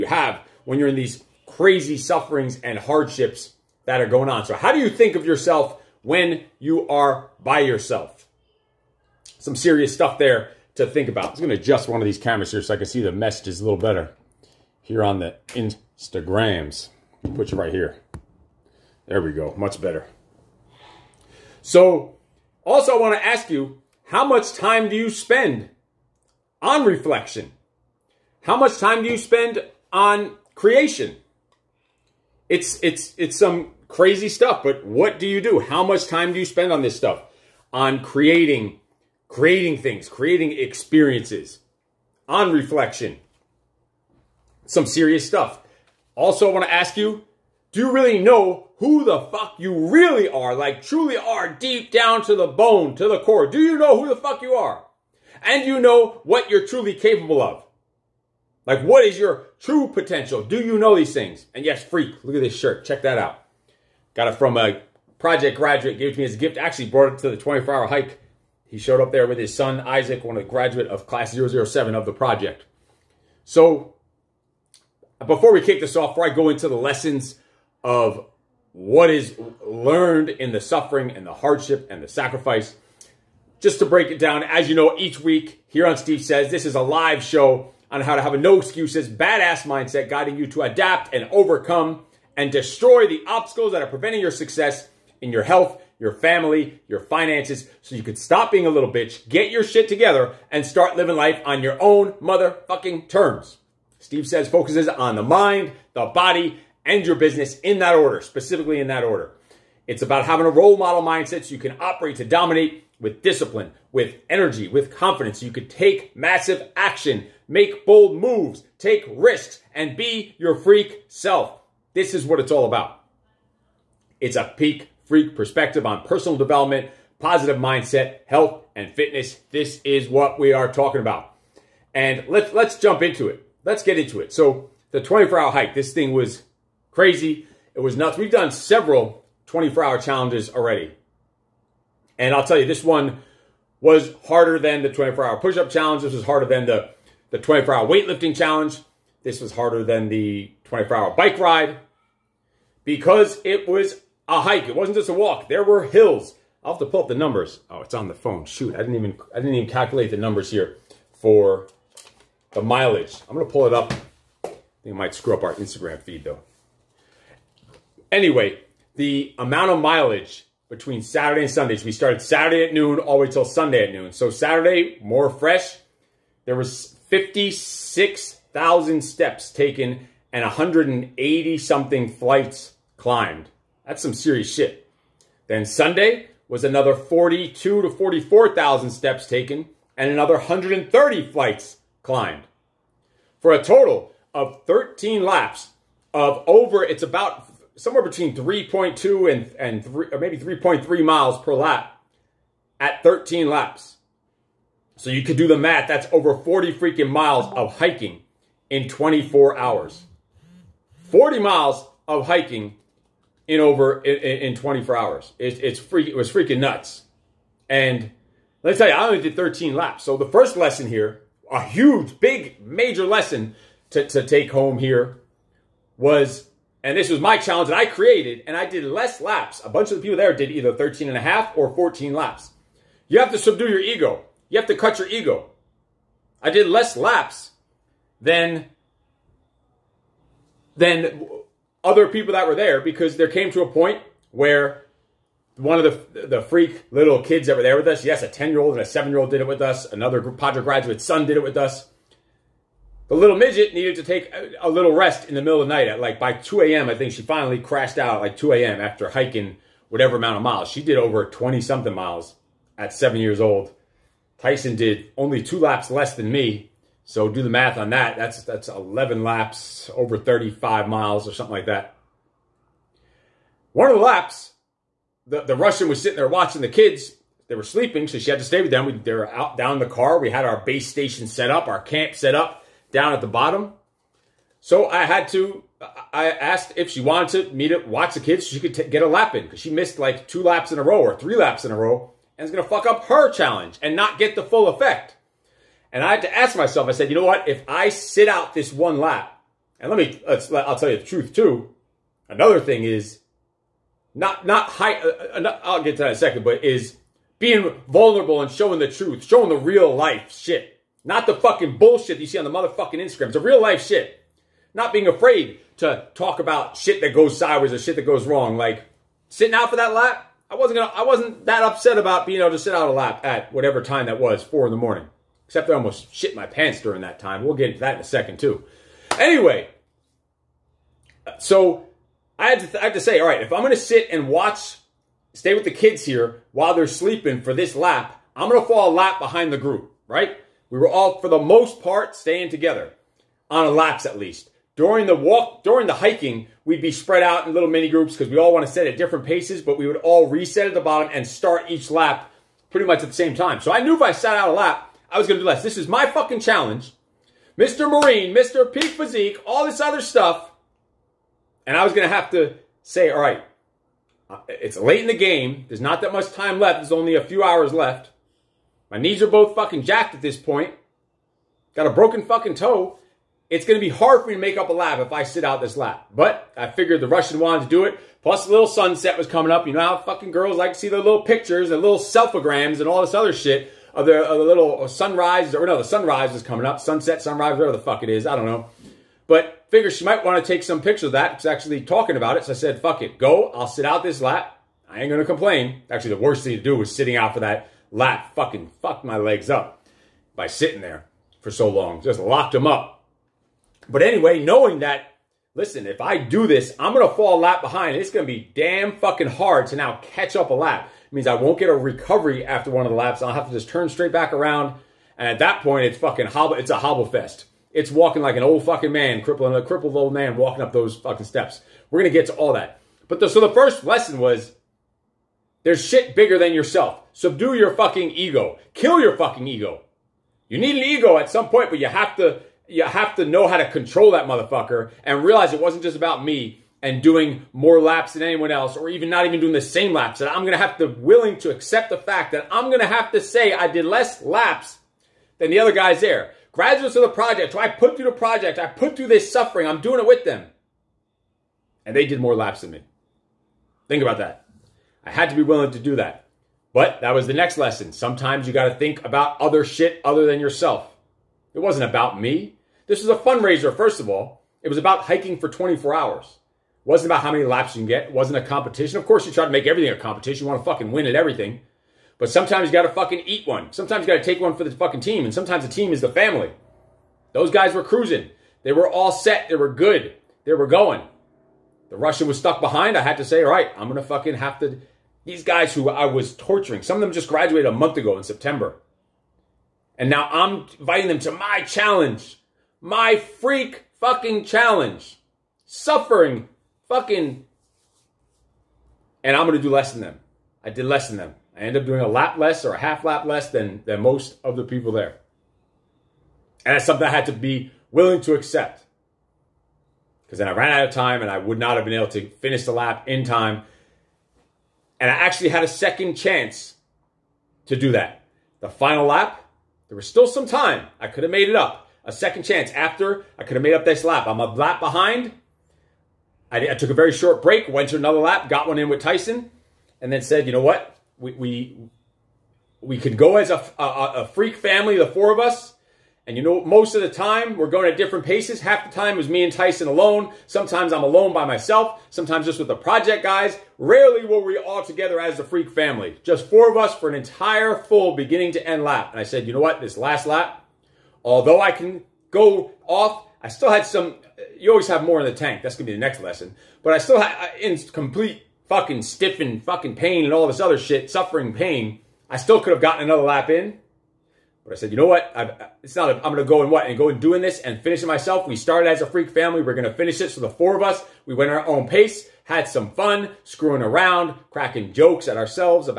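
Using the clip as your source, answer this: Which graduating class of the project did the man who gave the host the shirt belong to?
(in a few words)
Class 007.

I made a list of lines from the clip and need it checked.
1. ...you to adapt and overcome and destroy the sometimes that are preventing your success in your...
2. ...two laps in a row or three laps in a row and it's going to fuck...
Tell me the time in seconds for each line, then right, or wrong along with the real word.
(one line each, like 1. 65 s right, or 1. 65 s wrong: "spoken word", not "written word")
1. 90 s wrong: "obstacles", not "sometimes"
2. 290 s right.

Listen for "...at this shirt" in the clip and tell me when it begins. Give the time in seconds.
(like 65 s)
62 s.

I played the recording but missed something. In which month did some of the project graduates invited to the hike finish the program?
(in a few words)
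September.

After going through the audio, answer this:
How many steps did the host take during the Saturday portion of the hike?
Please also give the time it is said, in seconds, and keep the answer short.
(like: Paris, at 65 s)
56,000, at 177 s.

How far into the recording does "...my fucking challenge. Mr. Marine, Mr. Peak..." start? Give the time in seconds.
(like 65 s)
355 s.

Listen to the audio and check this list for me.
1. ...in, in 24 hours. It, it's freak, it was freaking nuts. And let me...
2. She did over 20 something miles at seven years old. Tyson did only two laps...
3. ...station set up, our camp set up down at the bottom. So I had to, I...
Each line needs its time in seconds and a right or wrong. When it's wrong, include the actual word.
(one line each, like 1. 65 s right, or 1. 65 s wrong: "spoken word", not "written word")
1. 214 s right
2. 260 s right
3. 280 s right.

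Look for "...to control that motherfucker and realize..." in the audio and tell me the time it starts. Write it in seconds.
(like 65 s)
433 s.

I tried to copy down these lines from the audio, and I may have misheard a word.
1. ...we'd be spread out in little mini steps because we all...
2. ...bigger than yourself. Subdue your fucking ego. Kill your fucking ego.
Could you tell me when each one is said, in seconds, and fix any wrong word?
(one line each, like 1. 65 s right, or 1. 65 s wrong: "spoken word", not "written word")
1. 346 s wrong: "groups", not "steps"
2. 426 s right.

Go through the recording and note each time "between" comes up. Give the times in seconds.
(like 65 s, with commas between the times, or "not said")
170 s, 198 s.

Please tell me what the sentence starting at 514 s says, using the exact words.
And I actually had a second chance to do that.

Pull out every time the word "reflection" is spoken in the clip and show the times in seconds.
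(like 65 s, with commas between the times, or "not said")
26 s, 42 s.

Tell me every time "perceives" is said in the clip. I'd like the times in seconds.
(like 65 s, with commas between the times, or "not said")
not said.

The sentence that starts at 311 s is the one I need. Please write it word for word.
Not the fucking bullshit you see on the motherfucking Instagram.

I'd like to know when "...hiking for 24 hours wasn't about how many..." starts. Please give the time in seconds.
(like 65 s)
465 s.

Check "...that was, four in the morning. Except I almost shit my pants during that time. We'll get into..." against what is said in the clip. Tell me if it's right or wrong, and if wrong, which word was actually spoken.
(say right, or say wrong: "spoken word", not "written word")
right.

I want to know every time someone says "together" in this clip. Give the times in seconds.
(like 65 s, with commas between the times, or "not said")
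99 s, 342 s, 544 s.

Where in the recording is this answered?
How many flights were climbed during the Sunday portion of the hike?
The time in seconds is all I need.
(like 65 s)
190 s.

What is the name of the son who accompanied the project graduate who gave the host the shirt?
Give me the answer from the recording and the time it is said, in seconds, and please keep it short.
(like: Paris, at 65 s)
Isaac, at 69 s.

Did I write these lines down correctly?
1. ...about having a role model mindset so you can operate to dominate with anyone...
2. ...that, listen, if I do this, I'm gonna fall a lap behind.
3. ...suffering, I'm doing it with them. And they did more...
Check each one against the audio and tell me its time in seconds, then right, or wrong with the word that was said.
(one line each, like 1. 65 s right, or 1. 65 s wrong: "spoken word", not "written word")
1. 110 s wrong: "discipline", not "anyone"
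2. 404 s right
3. 449 s right.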